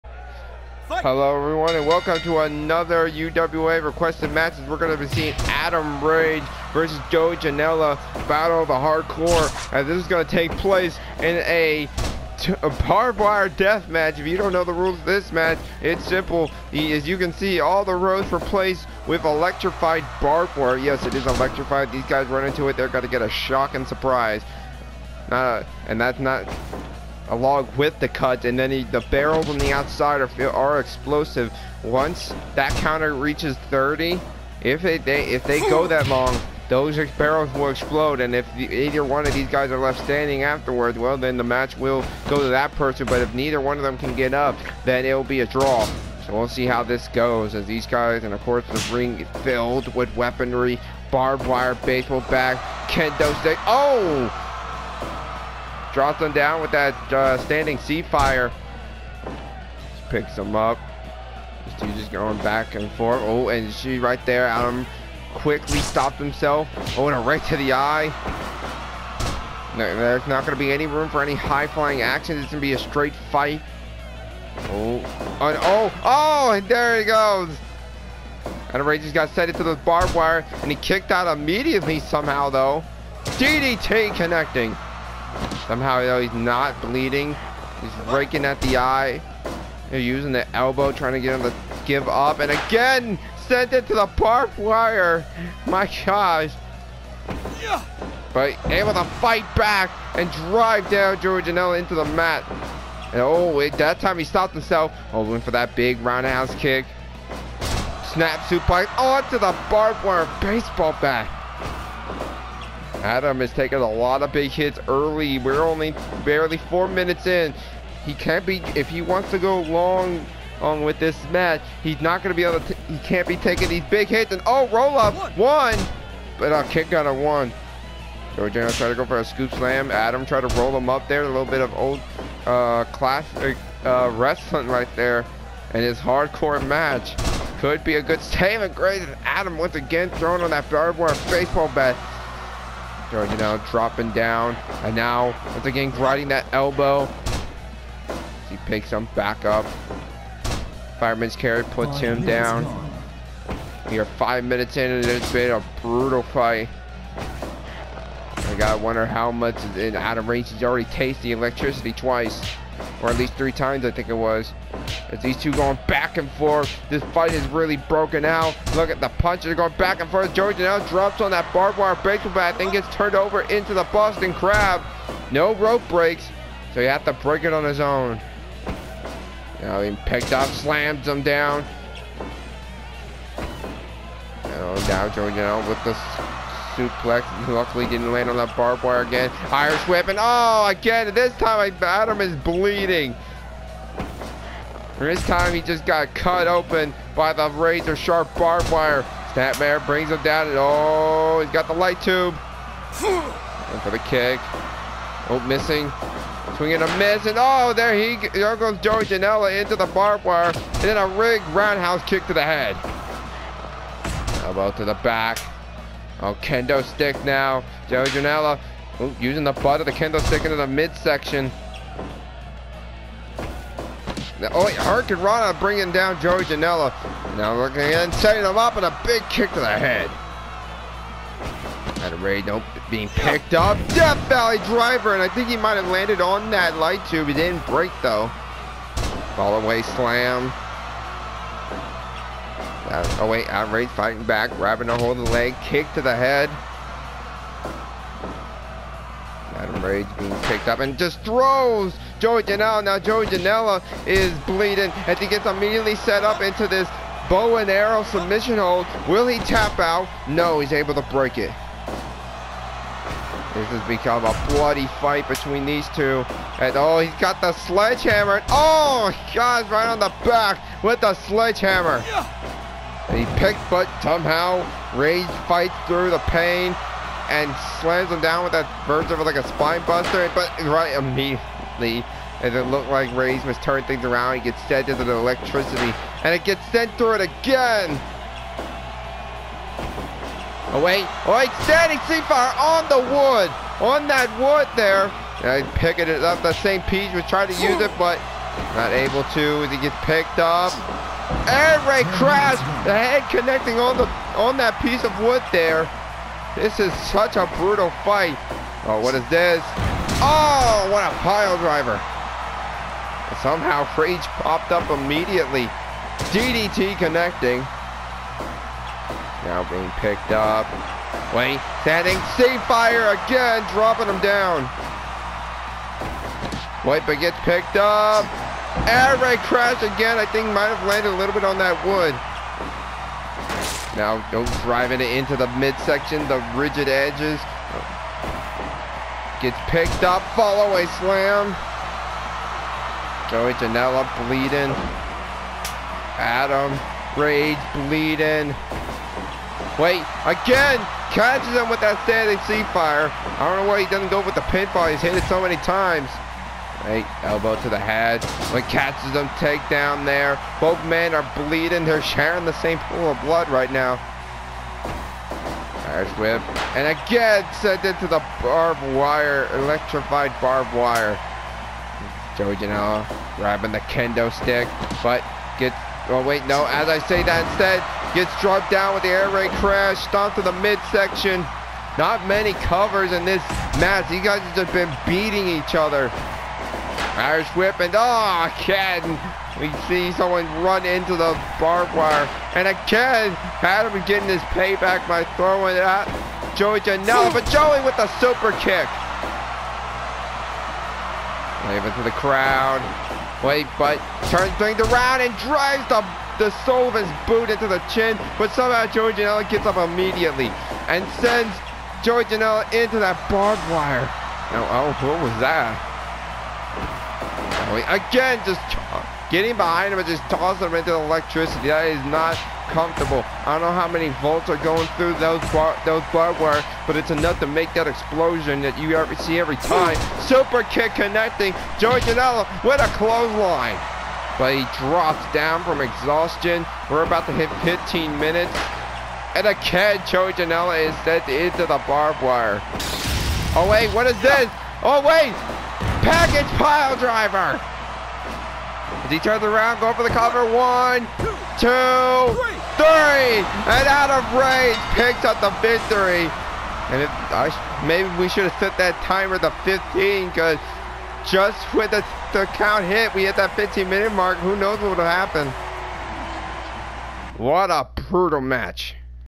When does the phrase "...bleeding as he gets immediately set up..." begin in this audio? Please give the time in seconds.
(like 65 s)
254 s.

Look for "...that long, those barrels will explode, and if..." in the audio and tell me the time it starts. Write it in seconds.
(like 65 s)
35 s.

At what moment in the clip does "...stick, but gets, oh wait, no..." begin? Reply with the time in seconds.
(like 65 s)
374 s.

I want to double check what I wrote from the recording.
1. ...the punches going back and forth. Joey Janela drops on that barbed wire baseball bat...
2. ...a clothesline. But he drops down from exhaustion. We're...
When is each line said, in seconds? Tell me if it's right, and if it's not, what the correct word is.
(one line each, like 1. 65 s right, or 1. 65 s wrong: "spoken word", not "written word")
1. 169 s right
2. 432 s right.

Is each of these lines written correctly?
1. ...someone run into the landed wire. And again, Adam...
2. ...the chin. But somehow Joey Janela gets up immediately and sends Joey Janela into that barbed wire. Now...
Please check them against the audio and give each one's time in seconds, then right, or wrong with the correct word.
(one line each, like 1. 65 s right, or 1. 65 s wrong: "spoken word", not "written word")
1. 390 s wrong: "barbed", not "landed"
2. 407 s right.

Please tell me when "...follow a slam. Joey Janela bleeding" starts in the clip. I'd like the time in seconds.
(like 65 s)
340 s.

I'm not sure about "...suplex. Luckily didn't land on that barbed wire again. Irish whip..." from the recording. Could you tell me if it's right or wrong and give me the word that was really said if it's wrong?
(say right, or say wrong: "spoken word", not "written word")
right.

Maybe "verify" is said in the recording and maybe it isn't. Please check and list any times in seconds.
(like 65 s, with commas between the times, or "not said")
not said.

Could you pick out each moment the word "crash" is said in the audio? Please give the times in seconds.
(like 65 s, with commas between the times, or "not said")
302 s, 329 s, 379 s.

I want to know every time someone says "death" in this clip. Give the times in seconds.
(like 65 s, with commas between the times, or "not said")
13 s, 233 s.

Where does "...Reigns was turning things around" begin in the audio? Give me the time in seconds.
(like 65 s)
283 s.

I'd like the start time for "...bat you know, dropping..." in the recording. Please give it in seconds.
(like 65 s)
141 s.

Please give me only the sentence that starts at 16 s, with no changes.
As you can see, all the roads were placed with electrified barbed wire.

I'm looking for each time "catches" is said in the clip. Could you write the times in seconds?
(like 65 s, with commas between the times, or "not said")
351 s, 358 s.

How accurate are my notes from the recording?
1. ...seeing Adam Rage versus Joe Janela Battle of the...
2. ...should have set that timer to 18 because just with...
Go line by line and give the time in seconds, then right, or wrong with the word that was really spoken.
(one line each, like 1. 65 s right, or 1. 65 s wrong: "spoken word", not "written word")
1. 5 s right
2. 458 s wrong: "15", not "18".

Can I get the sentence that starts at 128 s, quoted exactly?
Joey Janela tried to go for a scoop slam.